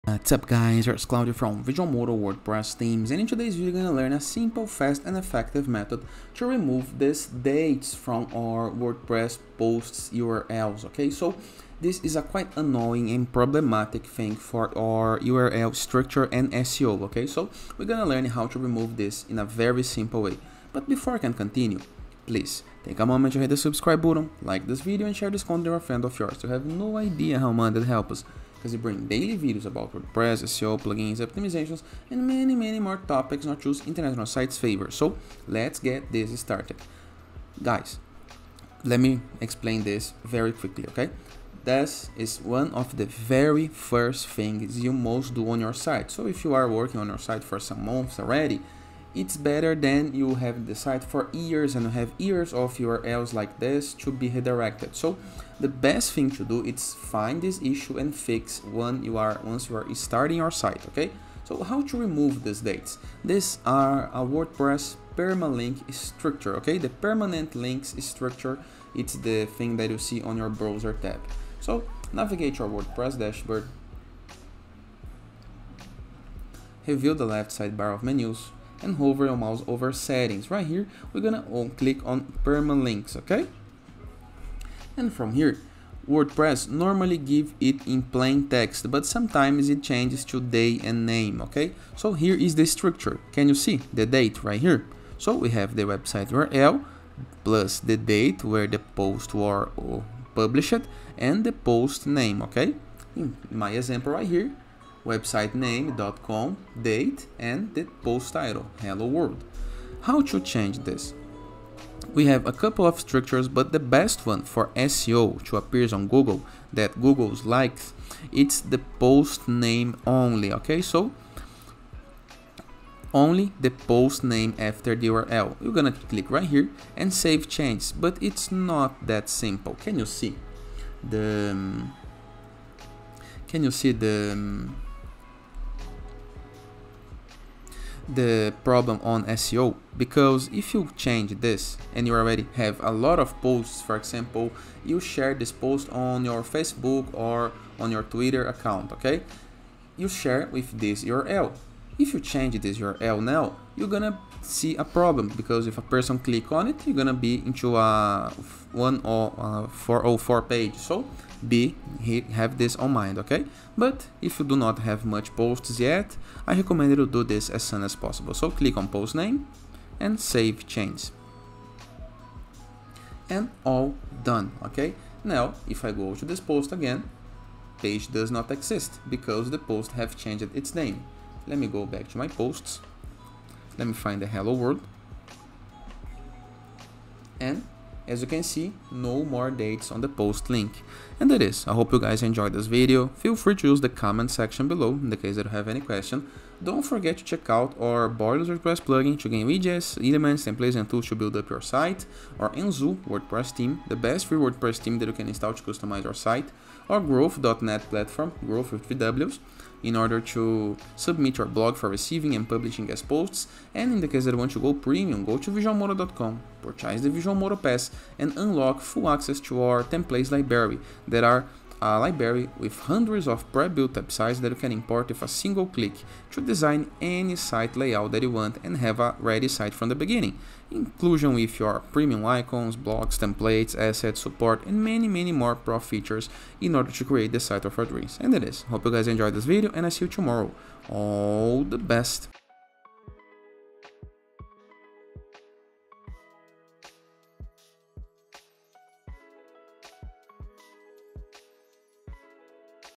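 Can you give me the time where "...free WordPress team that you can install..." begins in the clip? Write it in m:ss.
3:24.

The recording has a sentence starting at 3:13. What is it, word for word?
Feel free to use the comment section below in the case that you have any question.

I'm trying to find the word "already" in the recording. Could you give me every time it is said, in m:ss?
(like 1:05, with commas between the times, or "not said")
0:48, 2:22.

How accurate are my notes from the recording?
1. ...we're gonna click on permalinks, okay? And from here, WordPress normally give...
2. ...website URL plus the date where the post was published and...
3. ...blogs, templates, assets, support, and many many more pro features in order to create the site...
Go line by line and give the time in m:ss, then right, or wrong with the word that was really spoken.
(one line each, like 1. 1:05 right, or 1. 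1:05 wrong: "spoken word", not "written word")
1. 1:21 right
2. 1:35 right
3. 3:52 right.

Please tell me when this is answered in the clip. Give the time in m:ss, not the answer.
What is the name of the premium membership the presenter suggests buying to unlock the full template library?
3:37.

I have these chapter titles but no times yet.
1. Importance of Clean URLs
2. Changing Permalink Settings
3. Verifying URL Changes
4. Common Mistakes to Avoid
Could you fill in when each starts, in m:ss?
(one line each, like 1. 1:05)
1. 0:23
2. 1:30
3. 2:30
4. 3:10.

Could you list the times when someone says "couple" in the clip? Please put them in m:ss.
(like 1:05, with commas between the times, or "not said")
1:52.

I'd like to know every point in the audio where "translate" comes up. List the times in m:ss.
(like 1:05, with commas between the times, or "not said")
not said.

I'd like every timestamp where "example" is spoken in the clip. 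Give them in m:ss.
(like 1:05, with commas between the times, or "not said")
1:43, 2:23.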